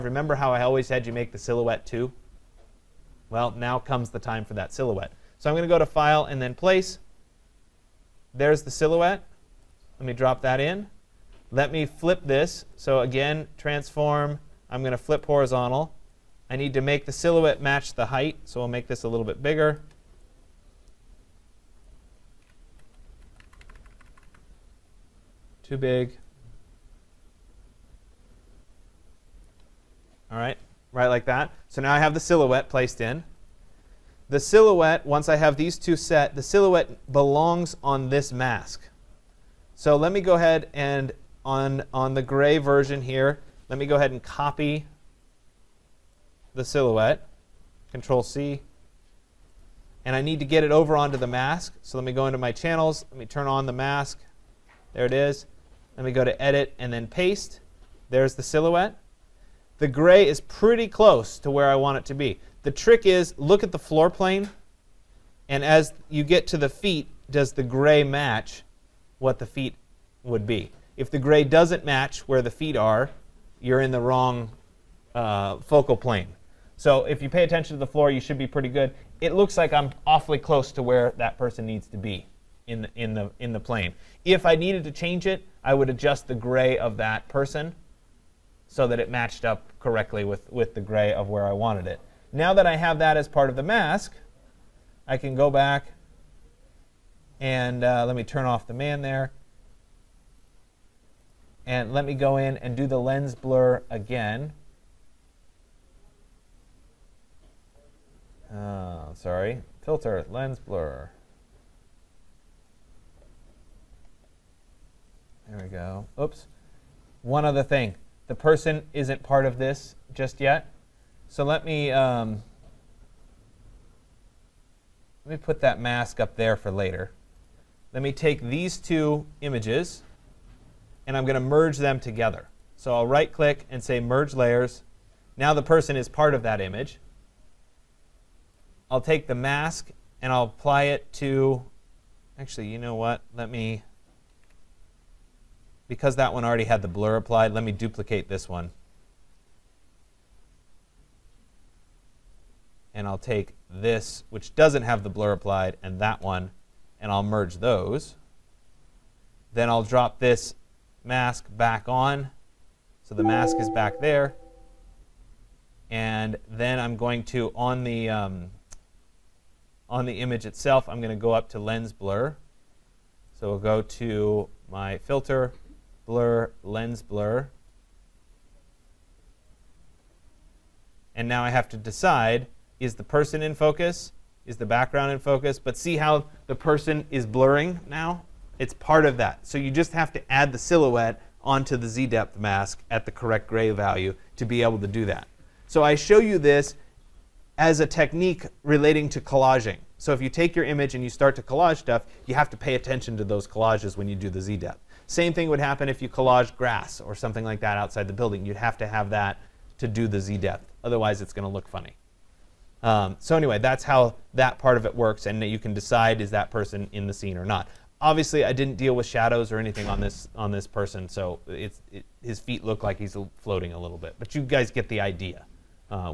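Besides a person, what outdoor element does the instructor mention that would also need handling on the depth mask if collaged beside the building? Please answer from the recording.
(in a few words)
Grass.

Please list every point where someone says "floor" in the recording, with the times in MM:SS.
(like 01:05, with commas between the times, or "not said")
01:03, 01:17.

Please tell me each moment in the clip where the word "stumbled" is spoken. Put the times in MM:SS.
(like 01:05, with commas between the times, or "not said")
not said.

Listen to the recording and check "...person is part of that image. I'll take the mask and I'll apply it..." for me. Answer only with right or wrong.
right.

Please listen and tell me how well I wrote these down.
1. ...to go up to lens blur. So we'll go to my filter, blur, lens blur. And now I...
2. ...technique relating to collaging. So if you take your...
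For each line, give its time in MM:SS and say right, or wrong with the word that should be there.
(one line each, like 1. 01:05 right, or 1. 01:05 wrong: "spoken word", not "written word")
1. 02:51 right
2. 03:17 right.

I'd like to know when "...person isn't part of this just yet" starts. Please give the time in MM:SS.
01:58.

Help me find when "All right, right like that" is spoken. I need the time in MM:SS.
00:30.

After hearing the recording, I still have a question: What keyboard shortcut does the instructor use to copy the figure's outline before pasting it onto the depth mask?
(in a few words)
Control C.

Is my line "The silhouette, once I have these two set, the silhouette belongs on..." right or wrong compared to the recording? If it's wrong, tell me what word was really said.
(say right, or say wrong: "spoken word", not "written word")
right.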